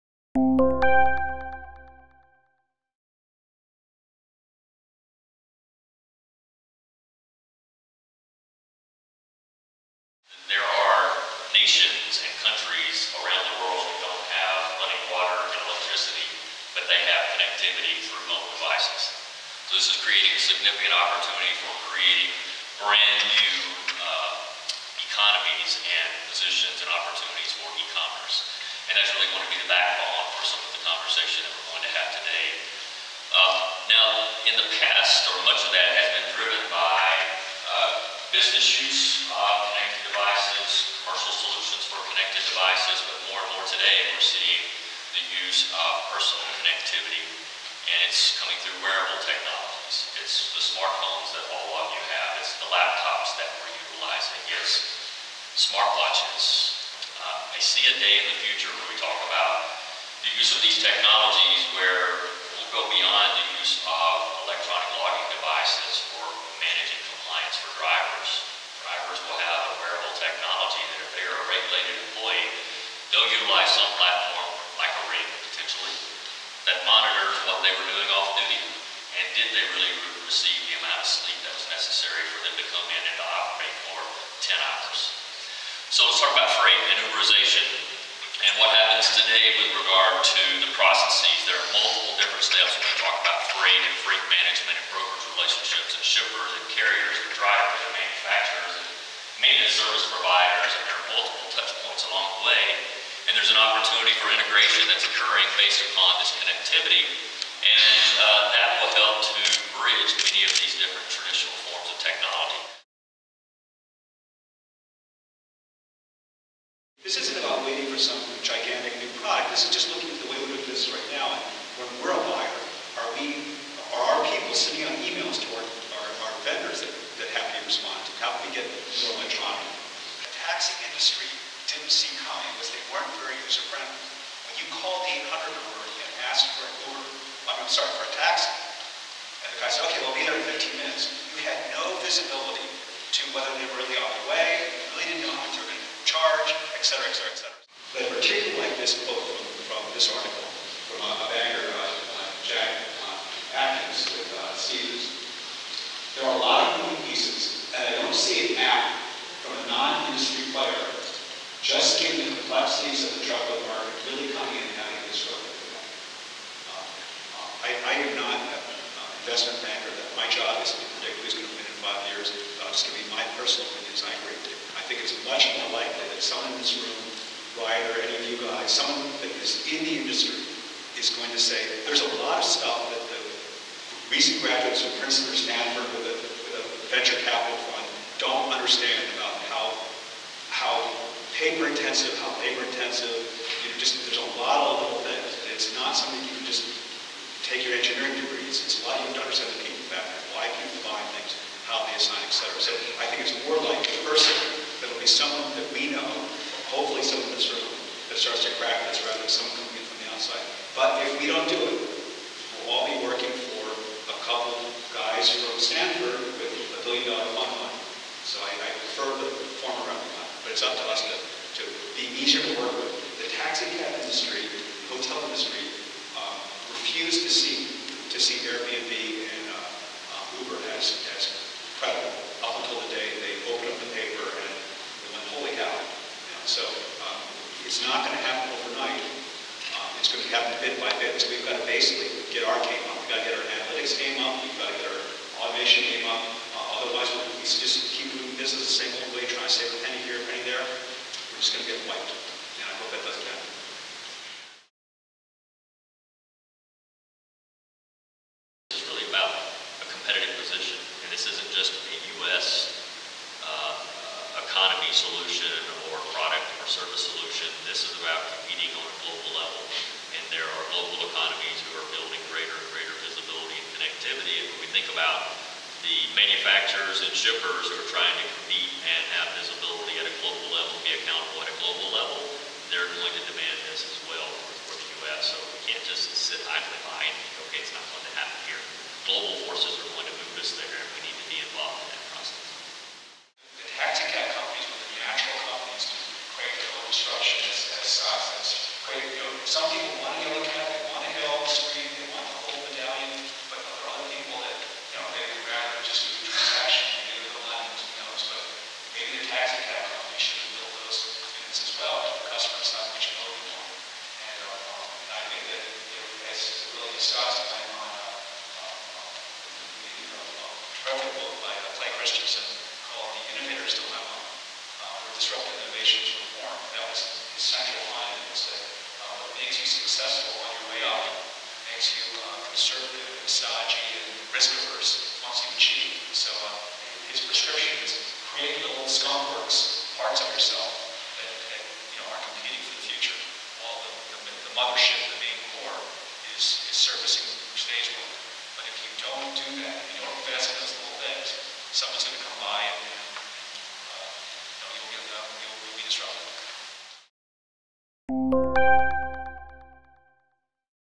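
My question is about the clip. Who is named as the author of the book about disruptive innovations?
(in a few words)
Clay Christensen.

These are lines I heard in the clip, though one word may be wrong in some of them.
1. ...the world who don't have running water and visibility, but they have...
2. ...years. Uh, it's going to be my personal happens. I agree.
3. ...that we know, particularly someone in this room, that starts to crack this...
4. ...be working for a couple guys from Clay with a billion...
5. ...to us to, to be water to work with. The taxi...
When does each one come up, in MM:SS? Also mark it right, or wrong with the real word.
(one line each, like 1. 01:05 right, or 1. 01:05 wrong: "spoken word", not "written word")
1. 00:13 wrong: "electricity", not "visibility"
2. 02:52 wrong: "opinions", not "happens"
3. 03:25 wrong: "hopefully", not "particularly"
4. 03:32 wrong: "Stanford", not "Clay"
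5. 03:40 wrong: "easier", not "water".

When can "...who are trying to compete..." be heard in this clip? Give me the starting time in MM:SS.
04:37.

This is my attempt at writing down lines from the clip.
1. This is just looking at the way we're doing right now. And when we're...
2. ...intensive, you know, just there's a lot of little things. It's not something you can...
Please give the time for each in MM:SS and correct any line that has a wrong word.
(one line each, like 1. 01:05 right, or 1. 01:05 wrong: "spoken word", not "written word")
1. 01:59 right
2. 03:12 right.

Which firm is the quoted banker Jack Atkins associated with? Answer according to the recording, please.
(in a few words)
Stephens.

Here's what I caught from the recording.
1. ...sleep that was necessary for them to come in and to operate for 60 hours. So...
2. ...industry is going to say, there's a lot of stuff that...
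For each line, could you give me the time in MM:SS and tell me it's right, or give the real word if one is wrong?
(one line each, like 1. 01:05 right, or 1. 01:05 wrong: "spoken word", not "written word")
1. 01:21 wrong: "10", not "60"
2. 03:00 right.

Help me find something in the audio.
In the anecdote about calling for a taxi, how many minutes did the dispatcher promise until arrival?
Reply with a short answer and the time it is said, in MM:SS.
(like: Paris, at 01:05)
15, at 02:20.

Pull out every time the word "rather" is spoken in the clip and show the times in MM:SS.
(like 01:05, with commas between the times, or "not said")
03:29, 03:39.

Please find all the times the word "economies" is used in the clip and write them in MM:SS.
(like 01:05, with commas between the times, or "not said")
00:24, 04:31.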